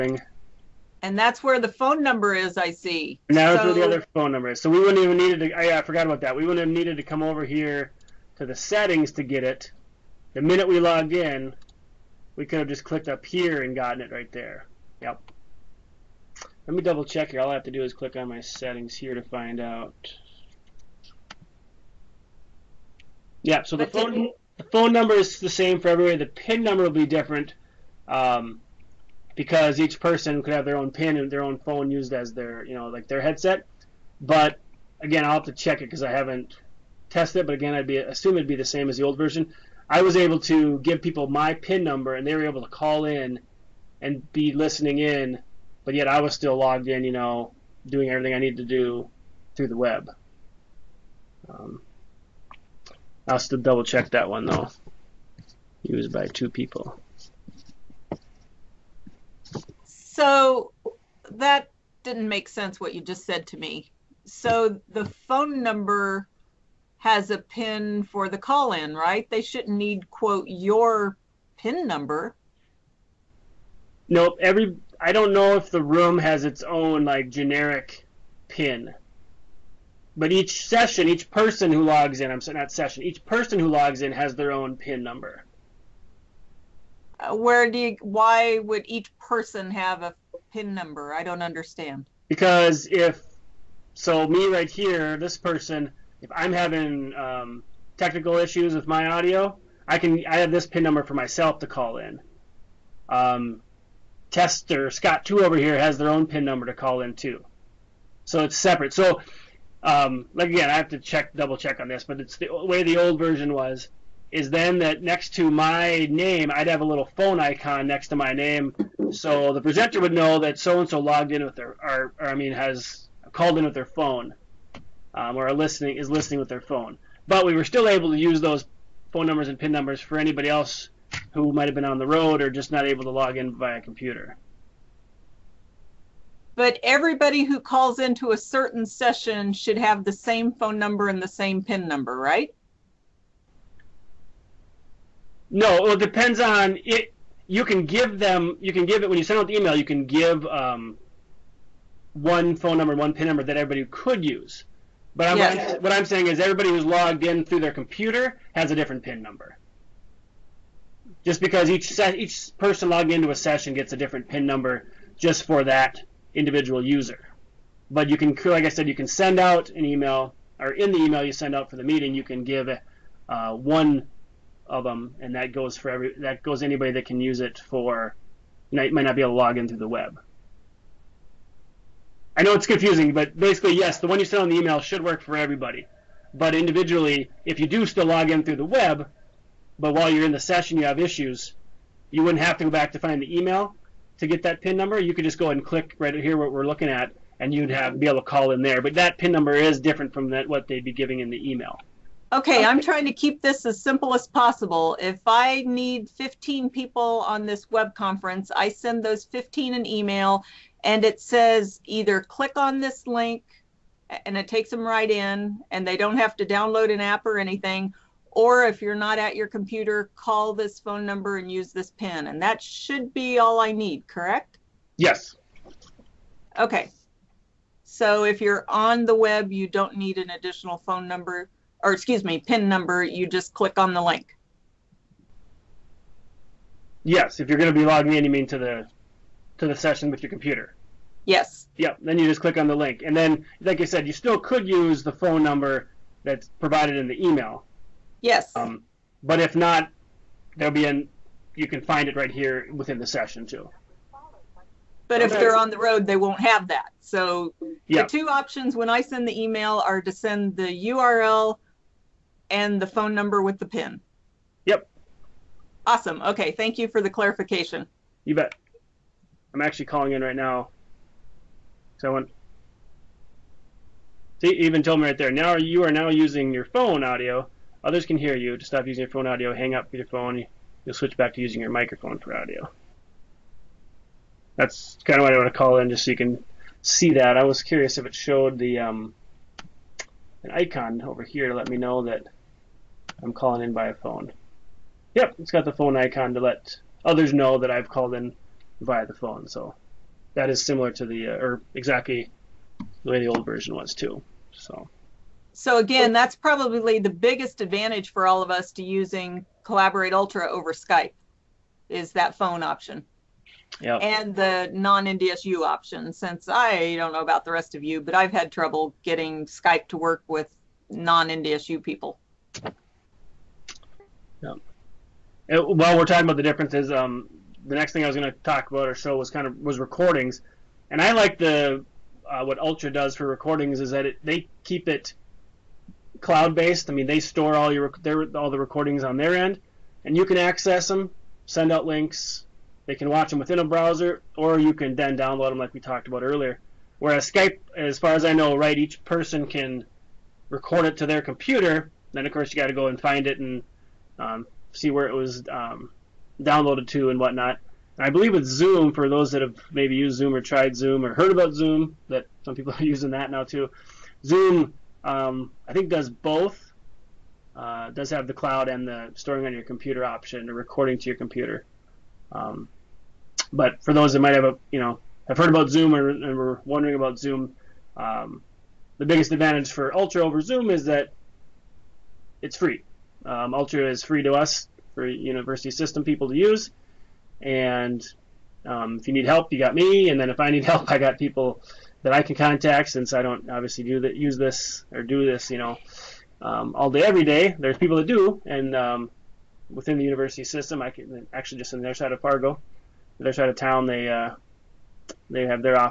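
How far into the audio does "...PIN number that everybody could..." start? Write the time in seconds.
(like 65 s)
153 s.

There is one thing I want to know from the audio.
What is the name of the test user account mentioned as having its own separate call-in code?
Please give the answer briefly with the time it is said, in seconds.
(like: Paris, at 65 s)
tester Scott two, at 104 s.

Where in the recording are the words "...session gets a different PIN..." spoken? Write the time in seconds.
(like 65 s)
163 s.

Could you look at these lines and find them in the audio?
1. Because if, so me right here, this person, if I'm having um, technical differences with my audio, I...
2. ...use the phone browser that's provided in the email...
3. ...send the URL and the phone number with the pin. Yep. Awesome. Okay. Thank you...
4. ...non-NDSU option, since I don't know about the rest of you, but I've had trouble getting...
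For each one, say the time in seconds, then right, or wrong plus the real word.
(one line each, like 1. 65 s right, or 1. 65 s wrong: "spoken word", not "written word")
1. 92 s wrong: "issues", not "differences"
2. 244 s wrong: "number", not "browser"
3. 260 s right
4. 314 s right.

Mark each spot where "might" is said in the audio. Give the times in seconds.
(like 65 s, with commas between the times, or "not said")
131 s, 178 s, 374 s.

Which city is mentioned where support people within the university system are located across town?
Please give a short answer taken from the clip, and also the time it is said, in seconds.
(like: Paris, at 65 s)
Fargo, at 402 s.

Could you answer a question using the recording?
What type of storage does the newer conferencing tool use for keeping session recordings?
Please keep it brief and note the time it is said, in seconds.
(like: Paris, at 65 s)
cloud based, at 336 s.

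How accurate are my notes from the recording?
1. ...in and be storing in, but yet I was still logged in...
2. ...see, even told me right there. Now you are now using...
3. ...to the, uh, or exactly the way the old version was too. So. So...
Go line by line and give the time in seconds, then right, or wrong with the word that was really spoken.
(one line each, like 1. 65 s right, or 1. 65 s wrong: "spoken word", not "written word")
1. 43 s wrong: "listening", not "storing"
2. 274 s right
3. 300 s right.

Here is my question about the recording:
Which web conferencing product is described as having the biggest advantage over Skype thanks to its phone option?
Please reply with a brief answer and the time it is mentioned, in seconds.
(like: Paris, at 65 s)
Collaborate Ultra, at 309 s.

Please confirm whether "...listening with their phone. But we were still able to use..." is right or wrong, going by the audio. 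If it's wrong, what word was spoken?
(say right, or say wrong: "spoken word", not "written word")
right.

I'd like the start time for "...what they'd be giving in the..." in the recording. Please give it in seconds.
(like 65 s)
200 s.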